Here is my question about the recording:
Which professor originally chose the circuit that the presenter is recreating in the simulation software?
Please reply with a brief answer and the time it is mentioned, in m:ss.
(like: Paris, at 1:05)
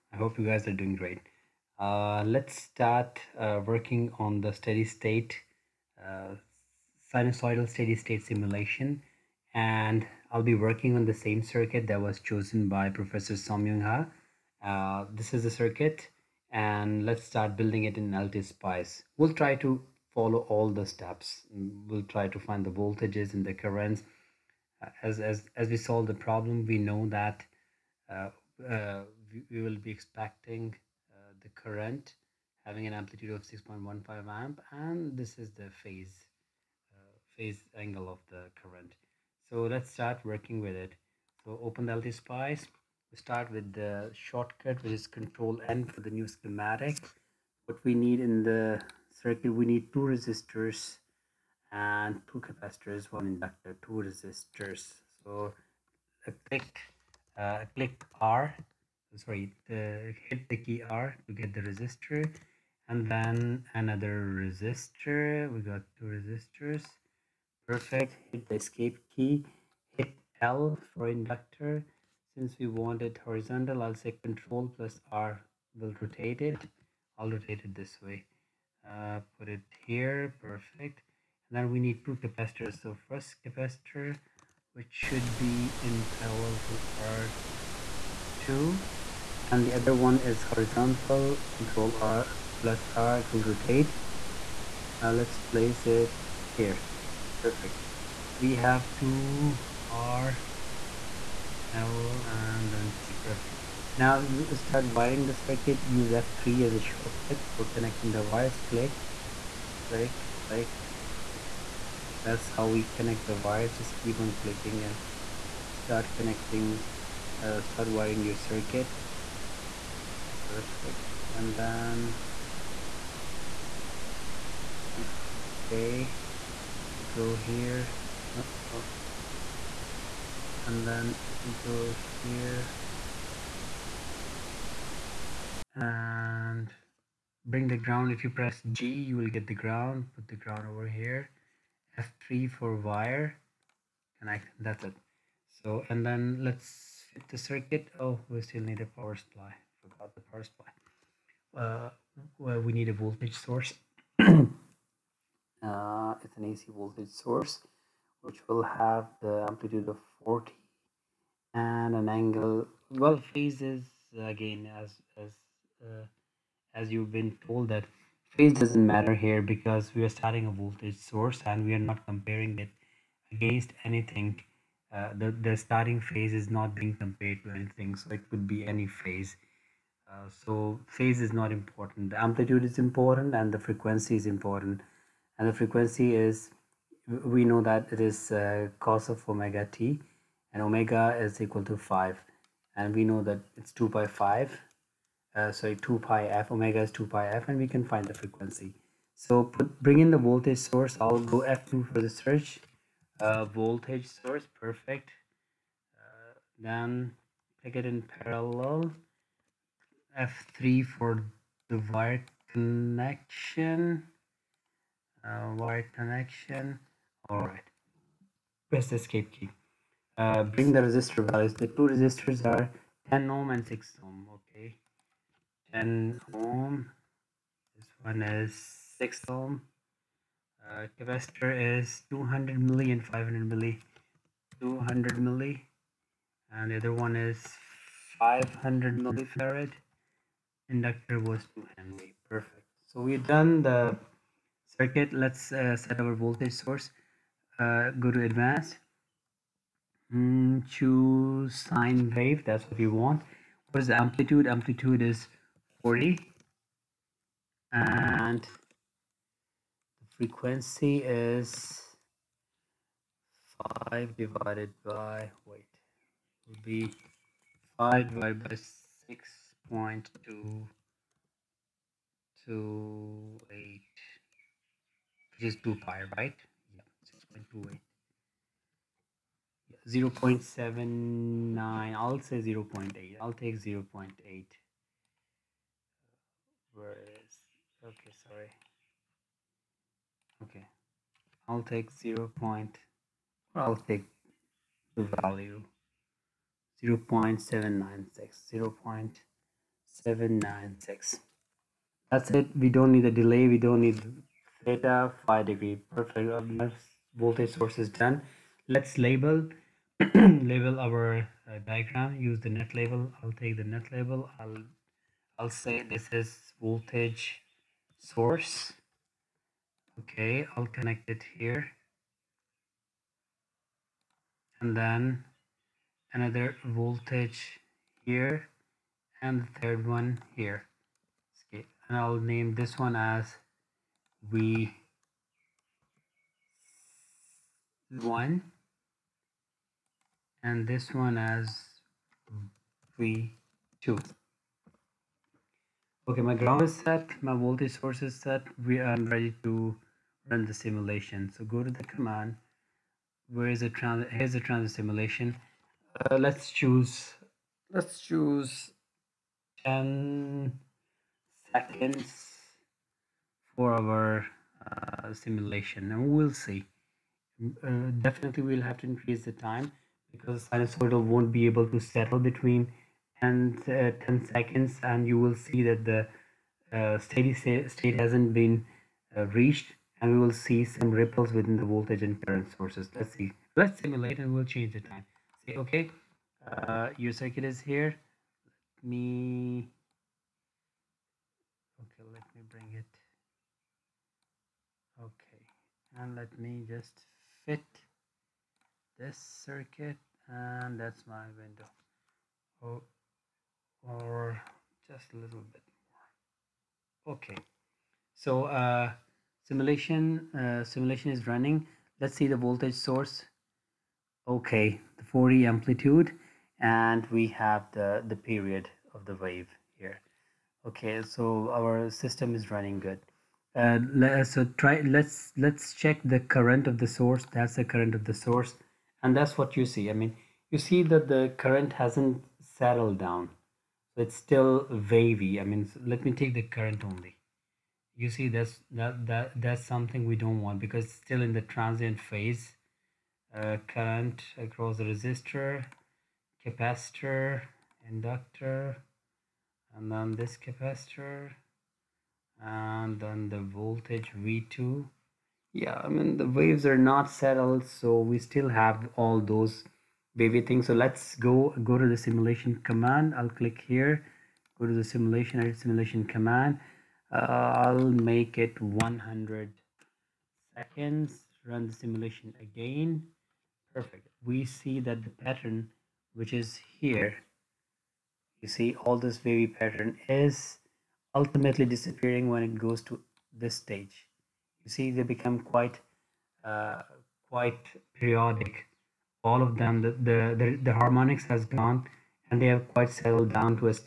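Somyung Ha, at 0:13.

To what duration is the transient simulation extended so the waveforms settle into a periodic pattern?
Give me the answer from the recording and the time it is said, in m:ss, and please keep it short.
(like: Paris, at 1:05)
100 seconds, at 7:48.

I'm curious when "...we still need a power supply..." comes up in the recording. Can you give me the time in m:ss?
2:28.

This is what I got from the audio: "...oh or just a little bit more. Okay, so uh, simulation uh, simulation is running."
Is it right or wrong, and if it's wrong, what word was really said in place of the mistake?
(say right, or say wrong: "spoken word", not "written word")
right.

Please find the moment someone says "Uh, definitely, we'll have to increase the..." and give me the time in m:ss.
6:07.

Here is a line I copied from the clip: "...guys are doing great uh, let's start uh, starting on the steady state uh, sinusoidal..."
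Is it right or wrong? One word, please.
wrong.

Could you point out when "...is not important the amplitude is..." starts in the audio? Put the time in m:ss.
3:01.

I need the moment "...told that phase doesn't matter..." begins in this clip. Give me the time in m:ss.
2:47.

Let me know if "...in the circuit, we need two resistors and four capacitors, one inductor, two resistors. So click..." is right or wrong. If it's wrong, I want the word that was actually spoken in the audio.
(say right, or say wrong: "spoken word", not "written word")
wrong: "two", not "four".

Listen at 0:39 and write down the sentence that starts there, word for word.
So let's start working with it.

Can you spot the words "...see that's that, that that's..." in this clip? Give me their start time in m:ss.
7:18.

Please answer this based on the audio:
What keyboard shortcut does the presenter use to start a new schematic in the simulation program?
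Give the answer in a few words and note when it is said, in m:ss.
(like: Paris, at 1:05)
Control N, at 0:45.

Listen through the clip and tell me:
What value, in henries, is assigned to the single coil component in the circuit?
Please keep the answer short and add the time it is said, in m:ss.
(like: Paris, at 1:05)
2, at 4:01.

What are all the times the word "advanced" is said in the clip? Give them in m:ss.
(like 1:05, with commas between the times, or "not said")
4:08.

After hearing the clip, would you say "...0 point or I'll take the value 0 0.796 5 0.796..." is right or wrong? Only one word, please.
wrong.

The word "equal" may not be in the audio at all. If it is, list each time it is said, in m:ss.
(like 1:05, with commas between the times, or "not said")
3:11.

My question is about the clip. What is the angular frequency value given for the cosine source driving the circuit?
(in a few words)
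5.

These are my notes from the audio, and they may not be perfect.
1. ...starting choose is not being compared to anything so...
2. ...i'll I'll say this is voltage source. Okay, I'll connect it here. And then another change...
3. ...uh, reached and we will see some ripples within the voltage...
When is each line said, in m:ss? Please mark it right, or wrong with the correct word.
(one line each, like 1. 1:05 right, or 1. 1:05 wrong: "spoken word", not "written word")
1. 2:55 wrong: "phase", not "choose"
2. 5:14 wrong: "voltage", not "change"
3. 6:19 right.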